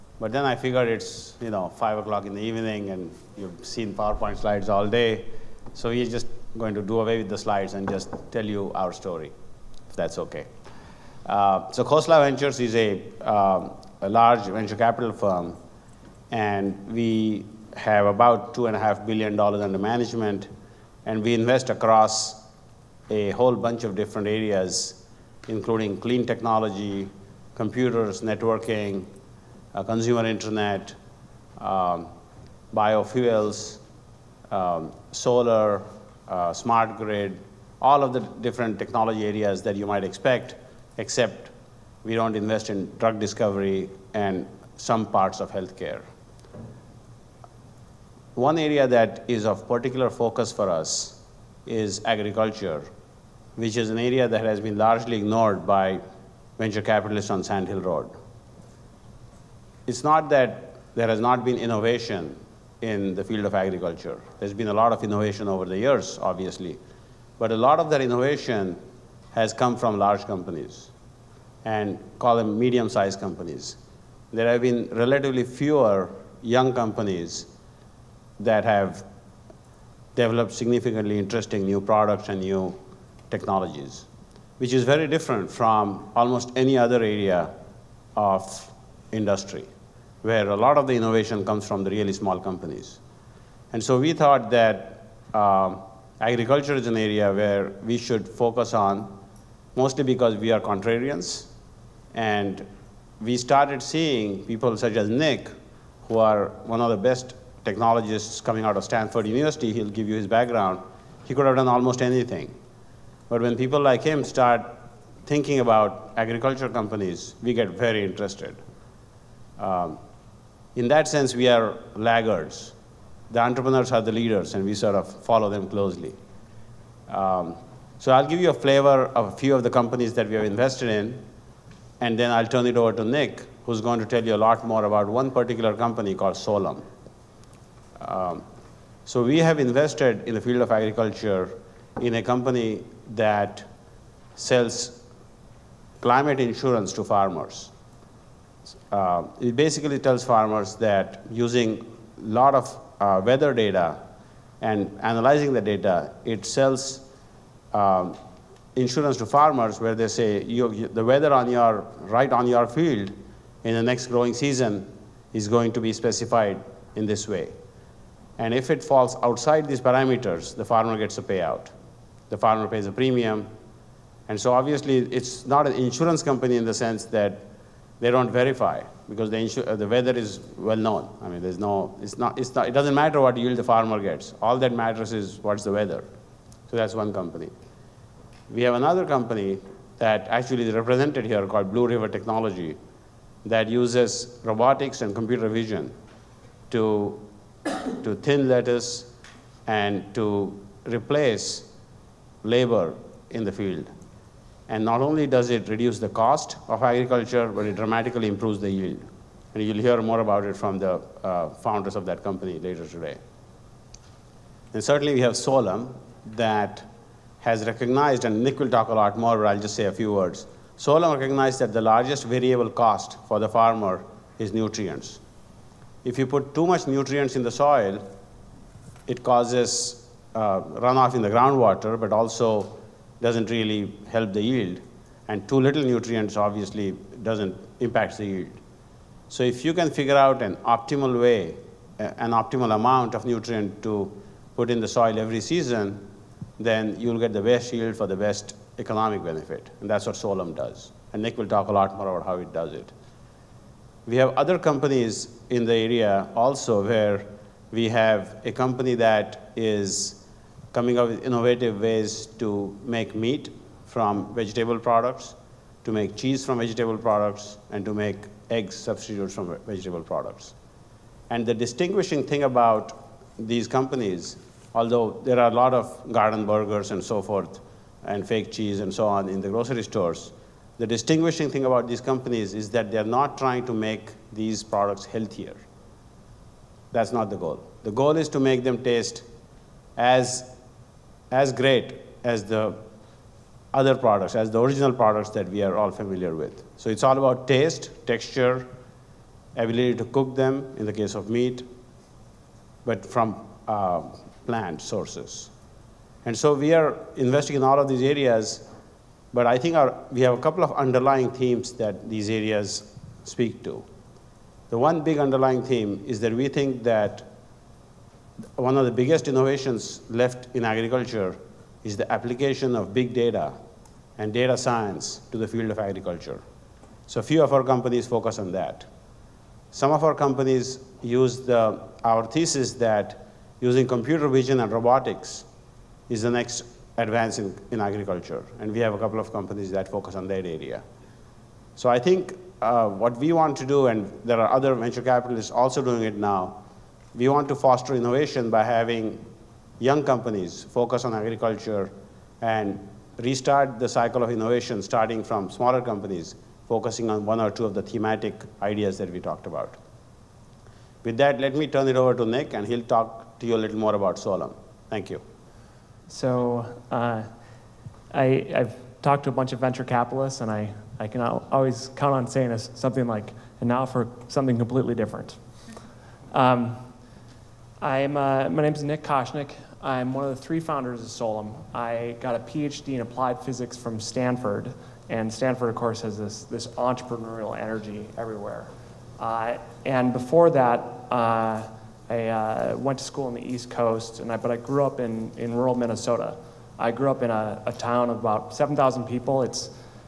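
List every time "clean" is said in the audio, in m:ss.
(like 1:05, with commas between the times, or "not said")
0:25.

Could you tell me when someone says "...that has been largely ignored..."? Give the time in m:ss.
0:54.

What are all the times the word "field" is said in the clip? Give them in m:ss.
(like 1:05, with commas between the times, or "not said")
1:03, 2:20, 2:42, 3:23, 5:25.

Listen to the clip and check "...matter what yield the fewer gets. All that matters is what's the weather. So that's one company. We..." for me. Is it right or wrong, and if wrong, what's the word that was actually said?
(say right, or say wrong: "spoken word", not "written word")
wrong: "farmer", not "fewer".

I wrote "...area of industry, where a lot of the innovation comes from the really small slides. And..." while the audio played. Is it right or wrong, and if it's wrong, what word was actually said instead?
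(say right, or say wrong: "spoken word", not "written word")
wrong: "companies", not "slides".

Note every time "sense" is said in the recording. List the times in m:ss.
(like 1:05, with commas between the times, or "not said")
2:01, 2:56.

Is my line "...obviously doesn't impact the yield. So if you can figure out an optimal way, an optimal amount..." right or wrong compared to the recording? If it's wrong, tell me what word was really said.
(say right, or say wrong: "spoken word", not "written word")
right.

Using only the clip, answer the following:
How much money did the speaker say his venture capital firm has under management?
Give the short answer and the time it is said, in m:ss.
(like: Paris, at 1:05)
$2.5 billion, at 0:18.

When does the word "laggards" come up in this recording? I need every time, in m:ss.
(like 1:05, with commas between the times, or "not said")
2:01.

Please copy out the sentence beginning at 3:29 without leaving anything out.
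And you'll hear more about it from the uh, founders of that company later today.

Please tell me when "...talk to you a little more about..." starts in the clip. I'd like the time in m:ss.
6:02.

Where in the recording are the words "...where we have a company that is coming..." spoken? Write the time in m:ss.
4:16.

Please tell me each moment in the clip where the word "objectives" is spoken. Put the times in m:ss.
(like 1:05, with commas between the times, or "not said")
not said.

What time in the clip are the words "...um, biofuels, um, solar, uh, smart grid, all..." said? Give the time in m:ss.
0:31.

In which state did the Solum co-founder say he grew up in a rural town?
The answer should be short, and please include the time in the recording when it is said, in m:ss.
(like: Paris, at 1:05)
Minnesota, at 6:35.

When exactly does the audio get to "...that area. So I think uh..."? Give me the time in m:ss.
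5:40.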